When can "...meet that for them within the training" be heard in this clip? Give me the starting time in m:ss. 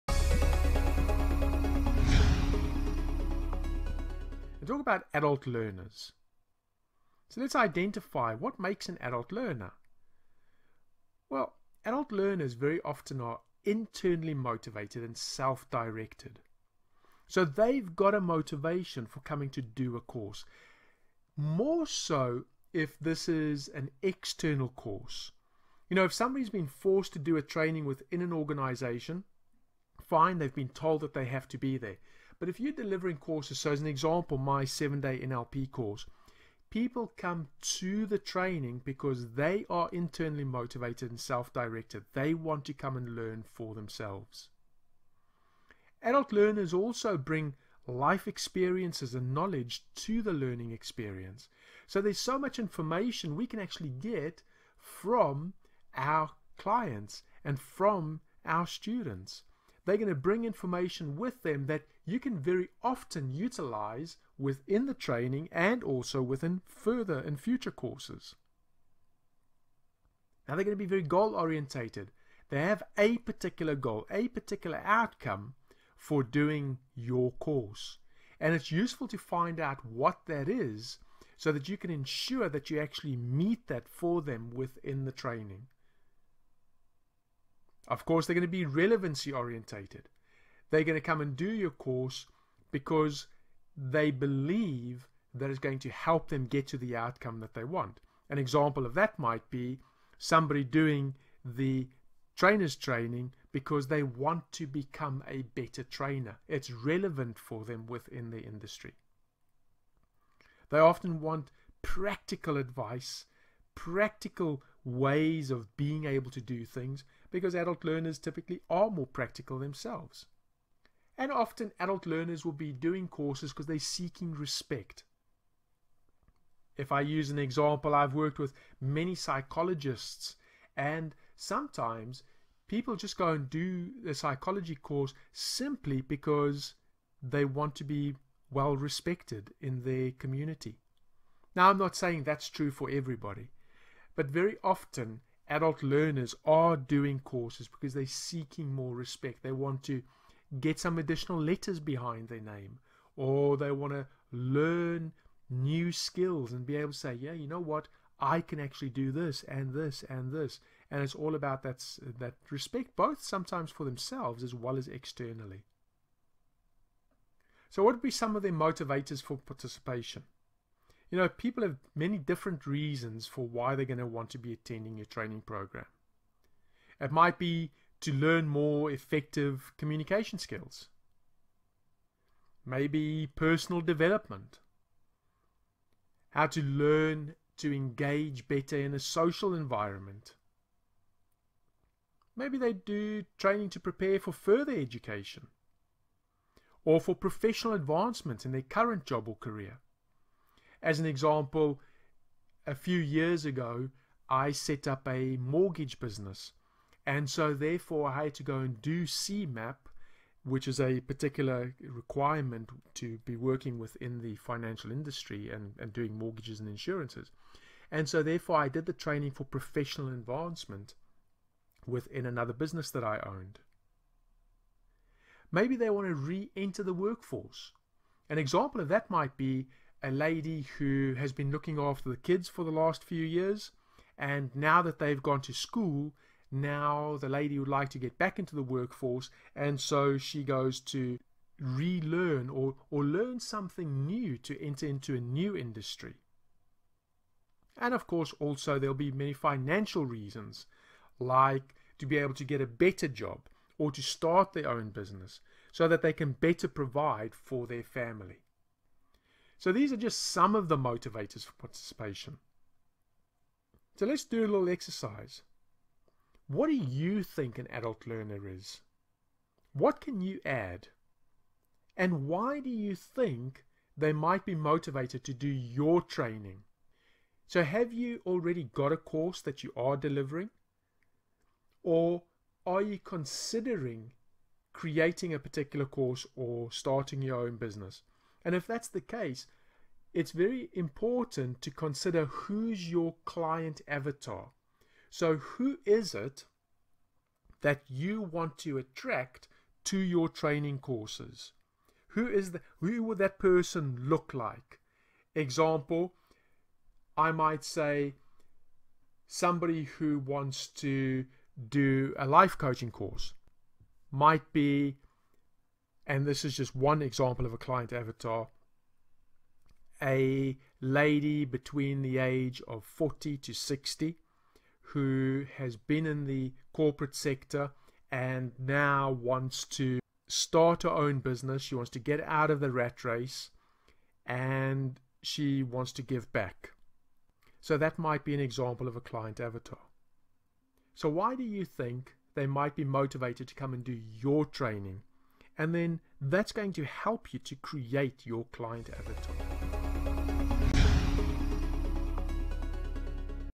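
1:23.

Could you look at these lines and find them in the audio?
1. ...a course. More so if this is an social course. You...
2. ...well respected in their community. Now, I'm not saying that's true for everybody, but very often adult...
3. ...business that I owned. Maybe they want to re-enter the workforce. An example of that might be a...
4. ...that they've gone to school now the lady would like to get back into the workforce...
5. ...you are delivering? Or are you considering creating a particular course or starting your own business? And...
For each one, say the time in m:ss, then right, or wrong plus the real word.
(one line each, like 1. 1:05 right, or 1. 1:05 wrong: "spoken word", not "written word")
1. 0:19 wrong: "external", not "social"
2. 2:18 right
3. 3:42 right
4. 3:54 right
5. 4:39 right.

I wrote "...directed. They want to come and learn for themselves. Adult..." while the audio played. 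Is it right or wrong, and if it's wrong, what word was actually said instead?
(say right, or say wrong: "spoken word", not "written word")
right.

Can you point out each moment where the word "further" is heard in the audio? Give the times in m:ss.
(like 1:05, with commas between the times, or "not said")
1:06, 3:14.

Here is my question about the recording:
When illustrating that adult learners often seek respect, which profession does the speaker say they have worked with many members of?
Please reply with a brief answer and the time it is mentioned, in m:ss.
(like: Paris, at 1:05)
psychologists, at 2:09.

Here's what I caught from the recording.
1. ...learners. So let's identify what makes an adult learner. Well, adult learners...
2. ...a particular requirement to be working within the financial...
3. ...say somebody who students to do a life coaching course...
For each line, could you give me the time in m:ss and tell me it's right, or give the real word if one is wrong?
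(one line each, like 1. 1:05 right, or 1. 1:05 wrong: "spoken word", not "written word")
1. 0:05 right
2. 3:30 right
3. 5:07 wrong: "wants", not "students".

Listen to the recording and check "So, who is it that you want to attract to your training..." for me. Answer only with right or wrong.
right.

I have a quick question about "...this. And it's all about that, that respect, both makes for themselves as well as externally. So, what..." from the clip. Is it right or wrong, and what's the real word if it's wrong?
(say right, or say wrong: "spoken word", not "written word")
wrong: "sometimes", not "makes".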